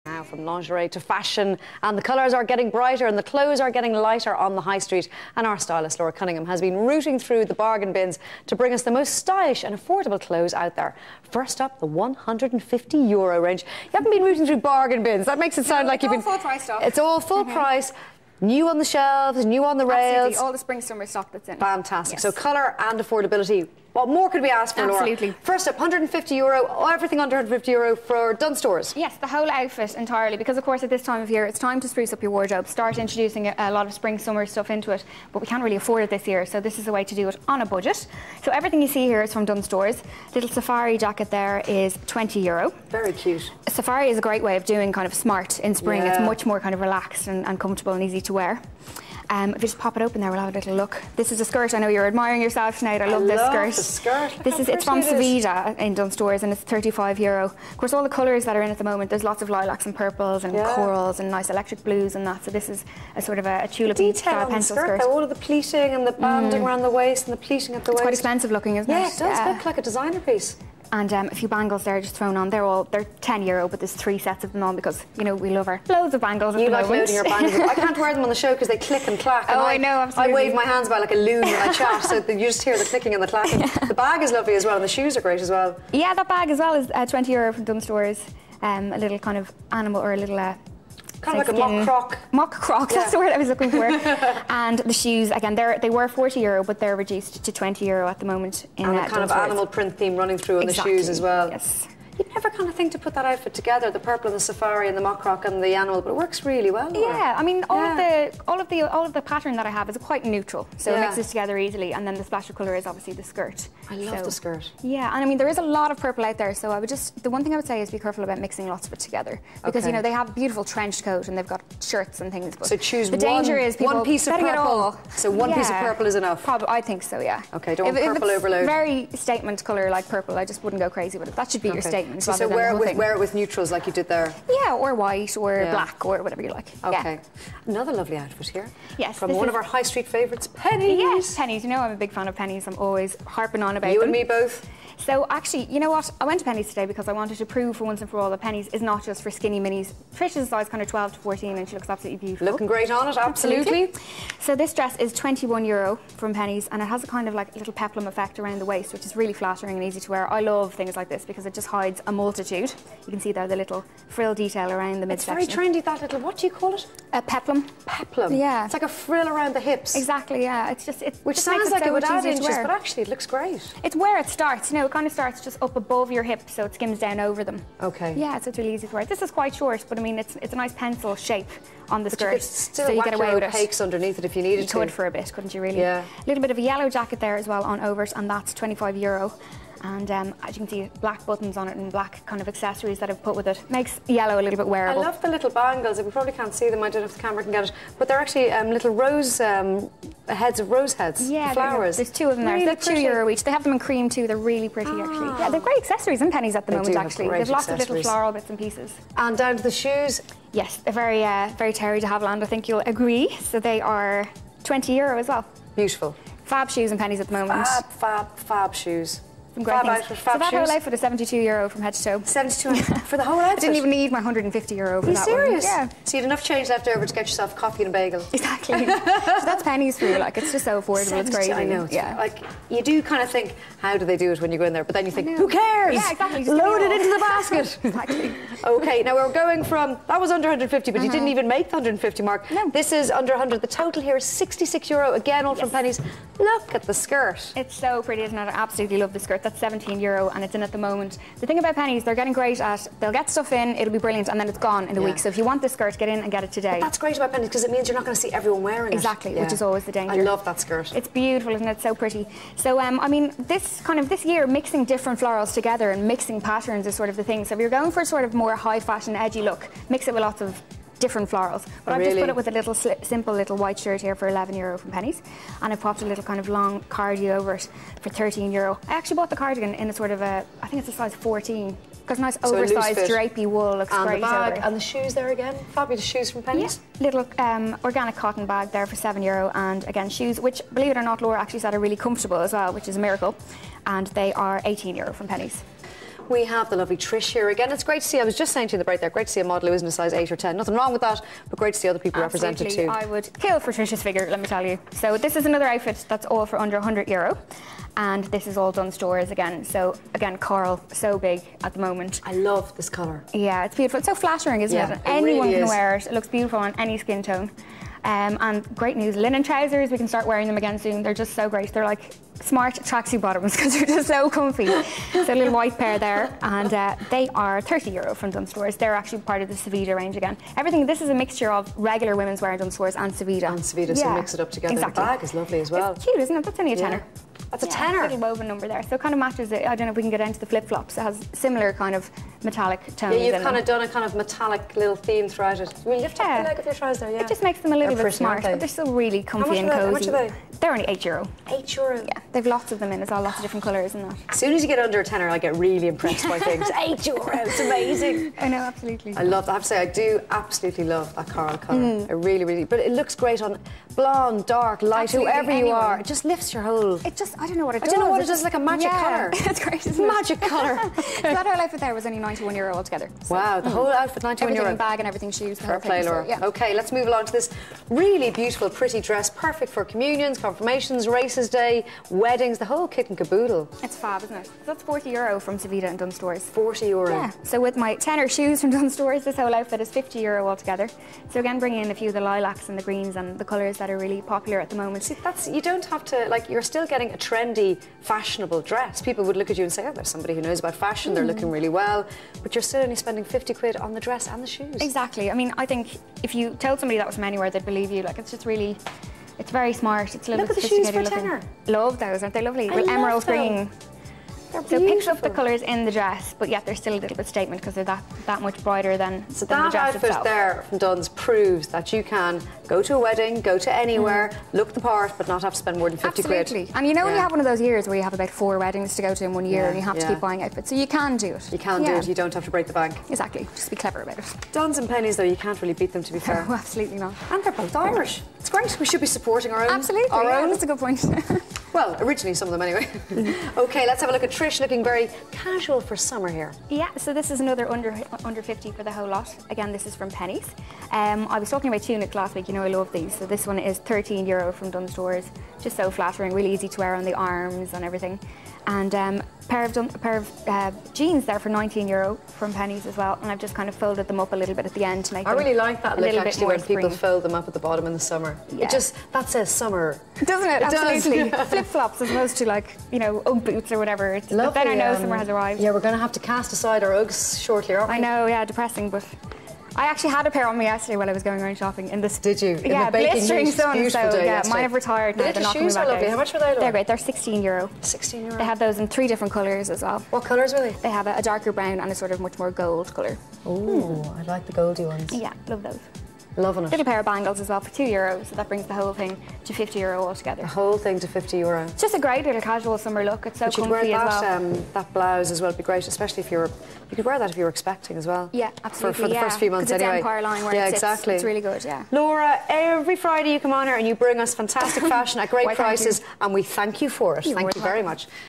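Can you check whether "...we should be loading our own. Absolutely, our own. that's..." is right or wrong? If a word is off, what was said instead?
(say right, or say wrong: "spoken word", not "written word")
wrong: "supporting", not "loading".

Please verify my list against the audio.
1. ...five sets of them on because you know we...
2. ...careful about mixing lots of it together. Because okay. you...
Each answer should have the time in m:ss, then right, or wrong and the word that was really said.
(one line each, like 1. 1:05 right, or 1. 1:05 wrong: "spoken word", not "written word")
1. 1:13 wrong: "three", not "five"
2. 1:57 right.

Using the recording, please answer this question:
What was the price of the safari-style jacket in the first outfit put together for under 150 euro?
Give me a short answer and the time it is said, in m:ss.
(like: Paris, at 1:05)
20 euro, at 0:40.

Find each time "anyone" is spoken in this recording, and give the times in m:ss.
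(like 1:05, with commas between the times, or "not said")
5:15, 6:05.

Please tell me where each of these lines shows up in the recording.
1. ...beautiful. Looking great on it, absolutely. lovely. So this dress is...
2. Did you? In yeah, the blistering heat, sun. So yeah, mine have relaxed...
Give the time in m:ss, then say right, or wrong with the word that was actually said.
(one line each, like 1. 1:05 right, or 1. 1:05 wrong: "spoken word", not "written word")
1. 2:32 wrong: "absolutely", not "lovely"
2. 8:02 wrong: "retired", not "relaxed".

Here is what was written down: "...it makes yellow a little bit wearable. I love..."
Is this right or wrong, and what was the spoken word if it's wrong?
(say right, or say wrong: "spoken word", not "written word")
right.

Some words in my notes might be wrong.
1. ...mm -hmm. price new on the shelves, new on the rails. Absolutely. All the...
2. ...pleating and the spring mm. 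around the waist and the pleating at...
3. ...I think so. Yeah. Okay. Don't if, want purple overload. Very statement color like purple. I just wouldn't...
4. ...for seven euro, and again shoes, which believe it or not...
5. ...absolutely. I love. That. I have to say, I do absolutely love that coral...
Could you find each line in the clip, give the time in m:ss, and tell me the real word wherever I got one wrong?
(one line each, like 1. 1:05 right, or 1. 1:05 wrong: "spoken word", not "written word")
1. 0:17 right
2. 1:05 wrong: "banding", not "spring"
3. 2:06 right
4. 4:48 right
5. 5:58 right.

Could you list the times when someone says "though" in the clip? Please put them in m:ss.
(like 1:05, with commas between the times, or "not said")
1:05, 7:15.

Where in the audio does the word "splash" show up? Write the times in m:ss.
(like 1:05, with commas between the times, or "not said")
1:52.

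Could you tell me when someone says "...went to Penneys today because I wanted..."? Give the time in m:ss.
2:26.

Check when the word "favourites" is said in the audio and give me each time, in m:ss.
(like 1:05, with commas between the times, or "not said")
2:20.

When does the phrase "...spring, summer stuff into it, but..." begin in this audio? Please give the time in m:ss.
0:33.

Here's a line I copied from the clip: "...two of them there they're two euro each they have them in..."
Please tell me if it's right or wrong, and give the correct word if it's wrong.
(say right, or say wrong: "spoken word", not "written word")
right.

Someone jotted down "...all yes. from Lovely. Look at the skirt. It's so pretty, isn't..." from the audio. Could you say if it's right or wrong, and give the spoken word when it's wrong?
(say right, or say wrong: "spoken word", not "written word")
wrong: "Penneys", not "Lovely".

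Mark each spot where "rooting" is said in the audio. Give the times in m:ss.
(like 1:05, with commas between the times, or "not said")
0:06, 0:14.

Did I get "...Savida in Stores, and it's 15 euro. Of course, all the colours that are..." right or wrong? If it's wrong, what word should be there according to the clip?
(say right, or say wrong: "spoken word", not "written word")
wrong: "35", not "15".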